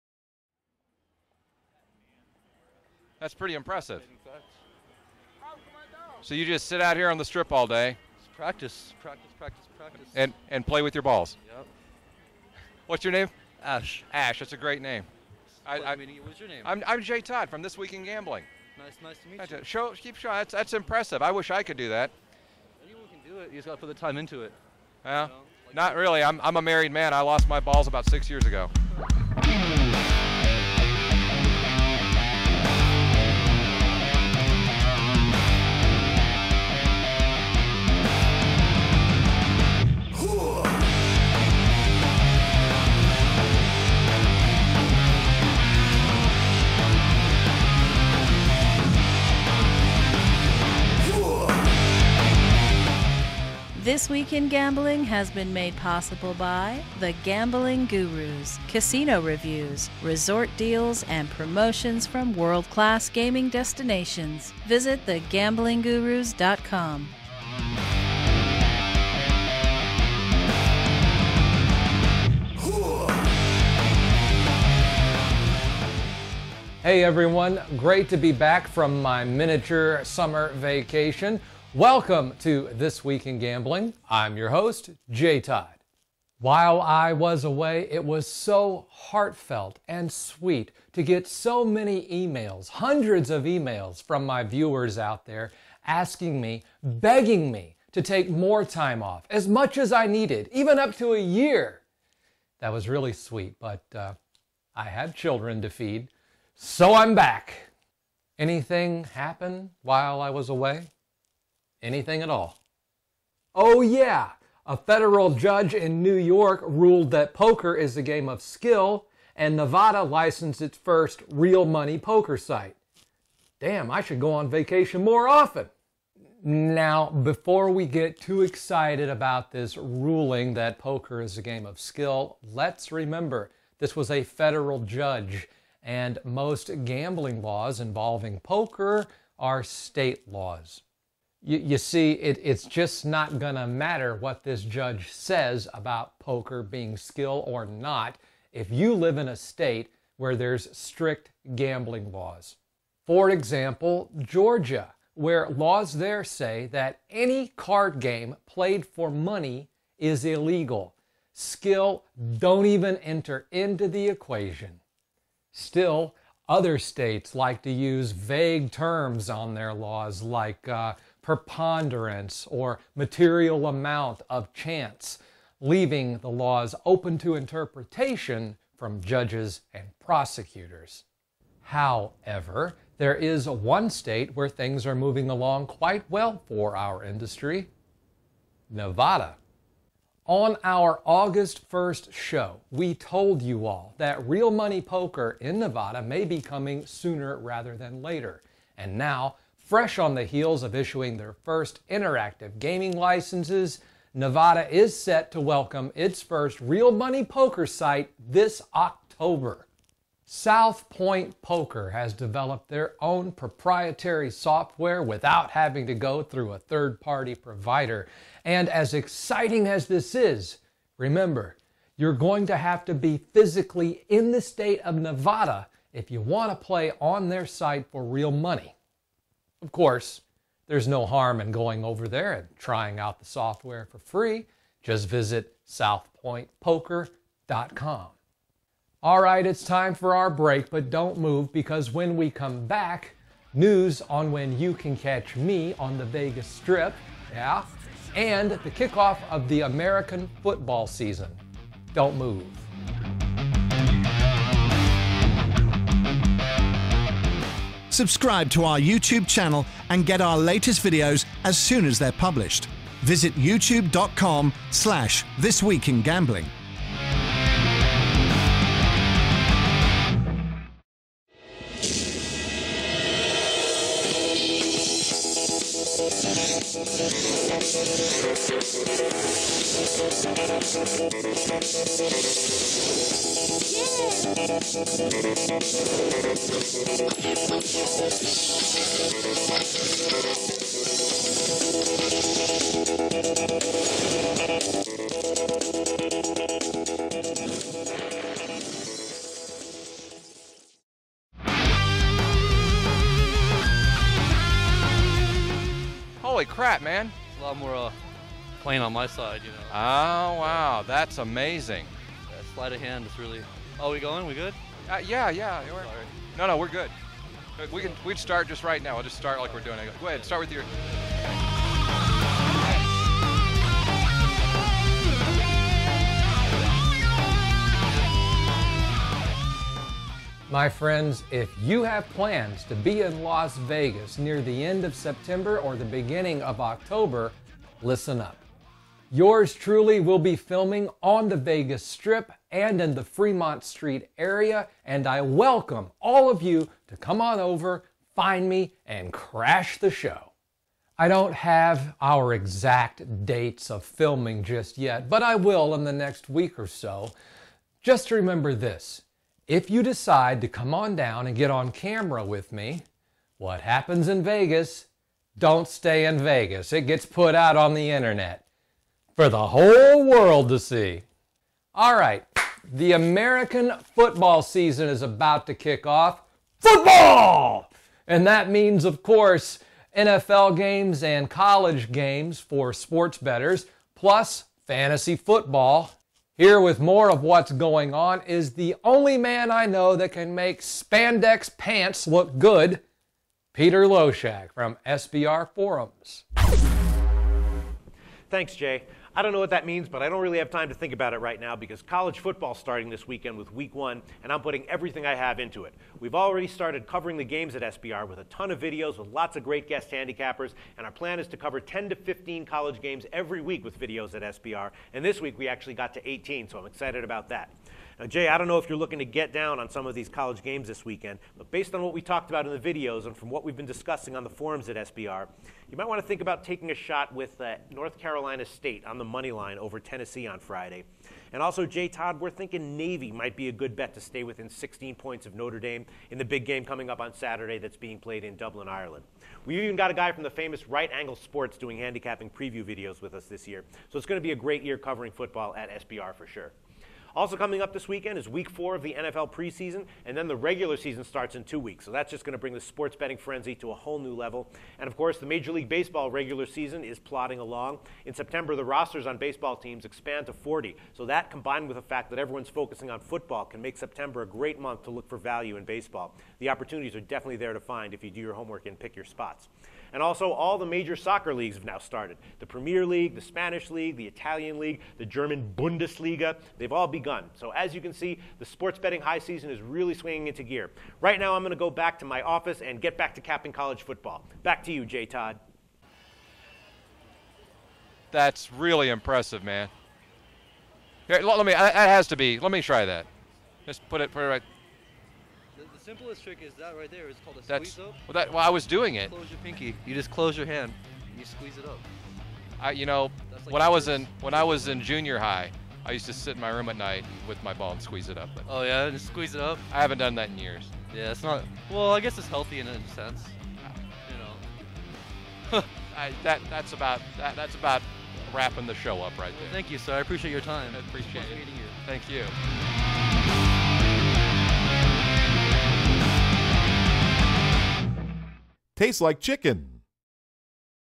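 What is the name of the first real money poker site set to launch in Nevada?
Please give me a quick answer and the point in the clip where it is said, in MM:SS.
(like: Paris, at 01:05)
South Point Poker, at 03:30.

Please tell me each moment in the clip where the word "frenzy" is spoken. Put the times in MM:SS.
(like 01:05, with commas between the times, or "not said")
07:33.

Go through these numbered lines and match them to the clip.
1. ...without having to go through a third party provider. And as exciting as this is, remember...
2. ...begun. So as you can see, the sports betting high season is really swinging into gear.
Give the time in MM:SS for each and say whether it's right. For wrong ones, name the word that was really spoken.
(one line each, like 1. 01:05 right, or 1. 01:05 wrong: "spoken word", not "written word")
1. 03:35 right
2. 07:57 right.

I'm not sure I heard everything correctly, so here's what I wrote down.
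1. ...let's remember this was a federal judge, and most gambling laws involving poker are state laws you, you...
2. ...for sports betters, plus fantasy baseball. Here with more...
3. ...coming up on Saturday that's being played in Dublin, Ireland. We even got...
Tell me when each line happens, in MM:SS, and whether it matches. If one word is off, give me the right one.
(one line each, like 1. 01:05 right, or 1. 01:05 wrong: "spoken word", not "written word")
1. 02:12 right
2. 06:22 wrong: "football", not "baseball"
3. 07:16 right.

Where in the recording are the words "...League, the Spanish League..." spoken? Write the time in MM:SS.
07:52.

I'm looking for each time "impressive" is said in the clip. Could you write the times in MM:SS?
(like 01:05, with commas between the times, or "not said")
00:03, 00:20, 08:08.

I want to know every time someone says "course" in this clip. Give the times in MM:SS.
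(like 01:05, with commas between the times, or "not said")
03:49, 06:19, 07:34.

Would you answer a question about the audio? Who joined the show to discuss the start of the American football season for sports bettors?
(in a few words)
Peter Loshak.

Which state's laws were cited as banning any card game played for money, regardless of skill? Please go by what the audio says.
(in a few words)
Georgia.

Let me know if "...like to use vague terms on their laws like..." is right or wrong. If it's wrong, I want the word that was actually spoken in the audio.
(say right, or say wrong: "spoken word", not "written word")
right.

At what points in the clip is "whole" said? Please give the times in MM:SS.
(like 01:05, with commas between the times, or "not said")
06:09, 07:33.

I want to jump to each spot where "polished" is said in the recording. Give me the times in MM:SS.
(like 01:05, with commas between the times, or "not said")
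not said.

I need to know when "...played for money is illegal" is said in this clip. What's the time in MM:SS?
02:38.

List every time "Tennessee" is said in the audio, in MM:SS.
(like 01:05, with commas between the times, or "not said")
07:09.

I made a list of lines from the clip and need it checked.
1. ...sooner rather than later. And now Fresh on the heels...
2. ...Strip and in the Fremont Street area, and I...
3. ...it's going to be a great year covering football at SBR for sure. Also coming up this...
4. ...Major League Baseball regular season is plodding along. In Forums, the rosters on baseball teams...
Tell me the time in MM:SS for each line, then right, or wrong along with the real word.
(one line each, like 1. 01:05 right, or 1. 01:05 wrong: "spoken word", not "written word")
1. 03:16 right
2. 05:41 right
3. 07:23 right
4. 07:35 wrong: "September", not "Forums".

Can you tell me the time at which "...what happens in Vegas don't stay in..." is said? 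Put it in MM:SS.
06:03.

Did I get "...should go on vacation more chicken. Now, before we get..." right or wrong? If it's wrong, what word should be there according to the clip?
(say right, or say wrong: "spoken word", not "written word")
wrong: "often", not "chicken".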